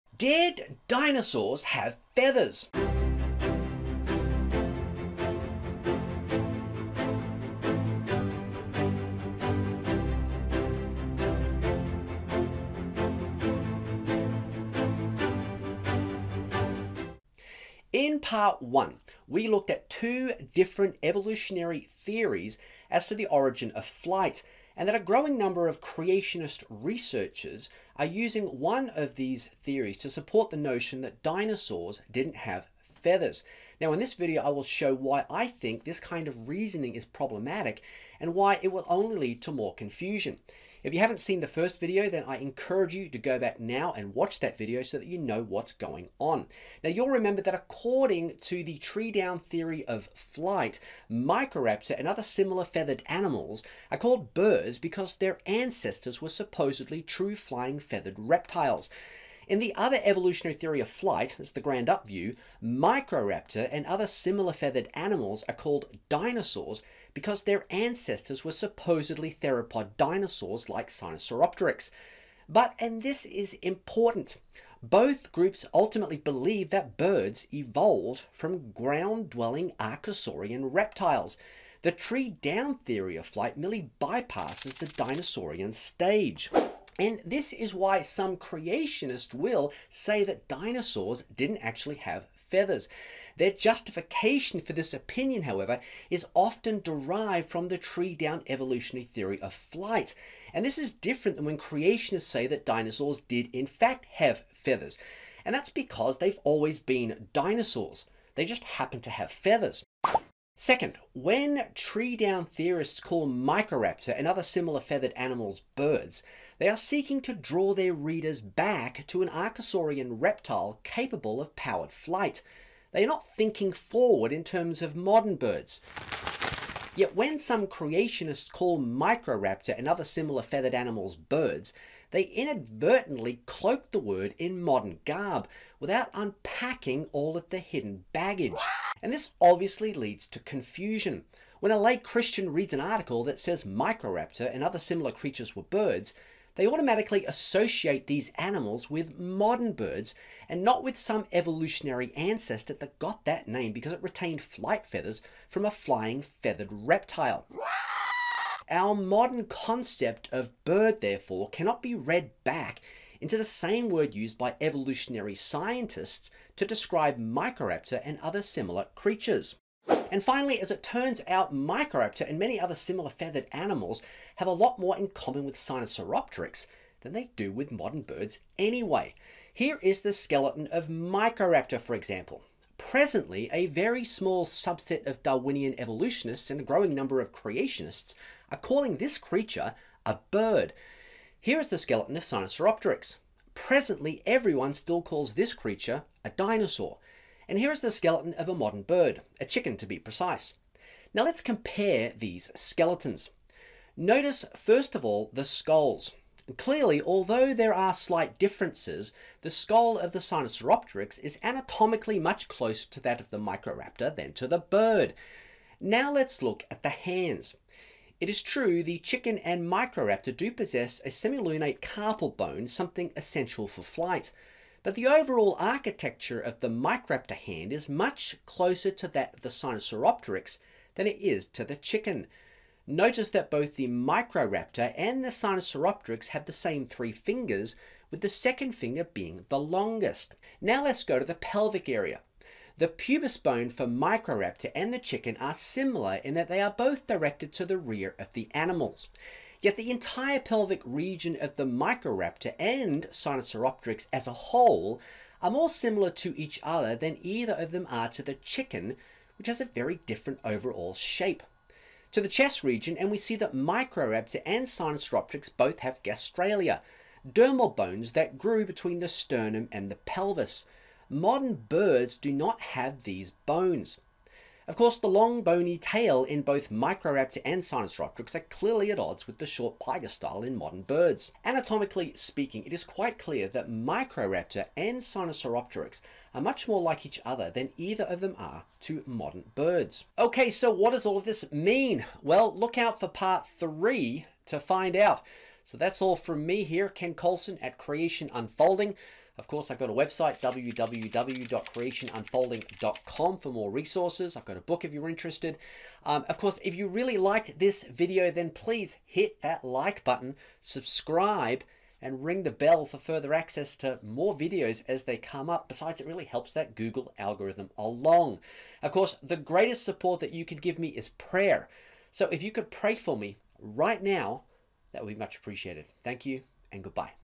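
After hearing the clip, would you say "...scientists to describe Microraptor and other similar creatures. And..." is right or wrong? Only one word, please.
right.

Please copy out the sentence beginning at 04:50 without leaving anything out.
Okay, so what does all of this mean?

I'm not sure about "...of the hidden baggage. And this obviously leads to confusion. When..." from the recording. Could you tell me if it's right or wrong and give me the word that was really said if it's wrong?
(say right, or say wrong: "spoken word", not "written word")
right.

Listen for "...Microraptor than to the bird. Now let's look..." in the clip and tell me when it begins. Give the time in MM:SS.
03:33.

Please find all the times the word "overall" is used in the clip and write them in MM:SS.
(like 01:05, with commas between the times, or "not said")
03:45, 04:20.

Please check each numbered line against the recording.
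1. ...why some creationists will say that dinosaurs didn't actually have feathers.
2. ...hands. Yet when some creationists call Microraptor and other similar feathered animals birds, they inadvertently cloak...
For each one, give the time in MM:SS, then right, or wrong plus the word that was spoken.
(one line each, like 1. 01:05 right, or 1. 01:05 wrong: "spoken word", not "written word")
1. 01:27 right
2. 02:05 wrong: "birds", not "hands".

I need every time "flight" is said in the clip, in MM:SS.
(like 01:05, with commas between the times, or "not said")
00:23, 00:50, 01:00, 01:23, 01:39, 02:01, 02:34, 03:43.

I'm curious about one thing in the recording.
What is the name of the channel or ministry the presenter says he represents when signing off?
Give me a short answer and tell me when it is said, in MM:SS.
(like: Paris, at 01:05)
Creation Unfolding, at 04:57.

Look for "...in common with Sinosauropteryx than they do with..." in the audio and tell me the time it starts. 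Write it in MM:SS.
02:54.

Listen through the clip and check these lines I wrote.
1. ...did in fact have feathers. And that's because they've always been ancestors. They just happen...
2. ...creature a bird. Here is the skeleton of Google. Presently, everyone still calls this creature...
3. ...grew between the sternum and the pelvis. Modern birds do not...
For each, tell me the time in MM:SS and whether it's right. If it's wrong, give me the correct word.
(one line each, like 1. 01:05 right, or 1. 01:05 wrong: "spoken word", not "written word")
1. 01:43 wrong: "dinosaurs", not "ancestors"
2. 03:09 wrong: "Sinosauropteryx", not "Google"
3. 04:28 right.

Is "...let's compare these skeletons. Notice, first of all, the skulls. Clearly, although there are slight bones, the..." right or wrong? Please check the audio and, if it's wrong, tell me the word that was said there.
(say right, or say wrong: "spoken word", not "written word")
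wrong: "differences", not "bones".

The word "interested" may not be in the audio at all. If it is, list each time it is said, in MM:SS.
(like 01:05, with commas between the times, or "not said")
05:05.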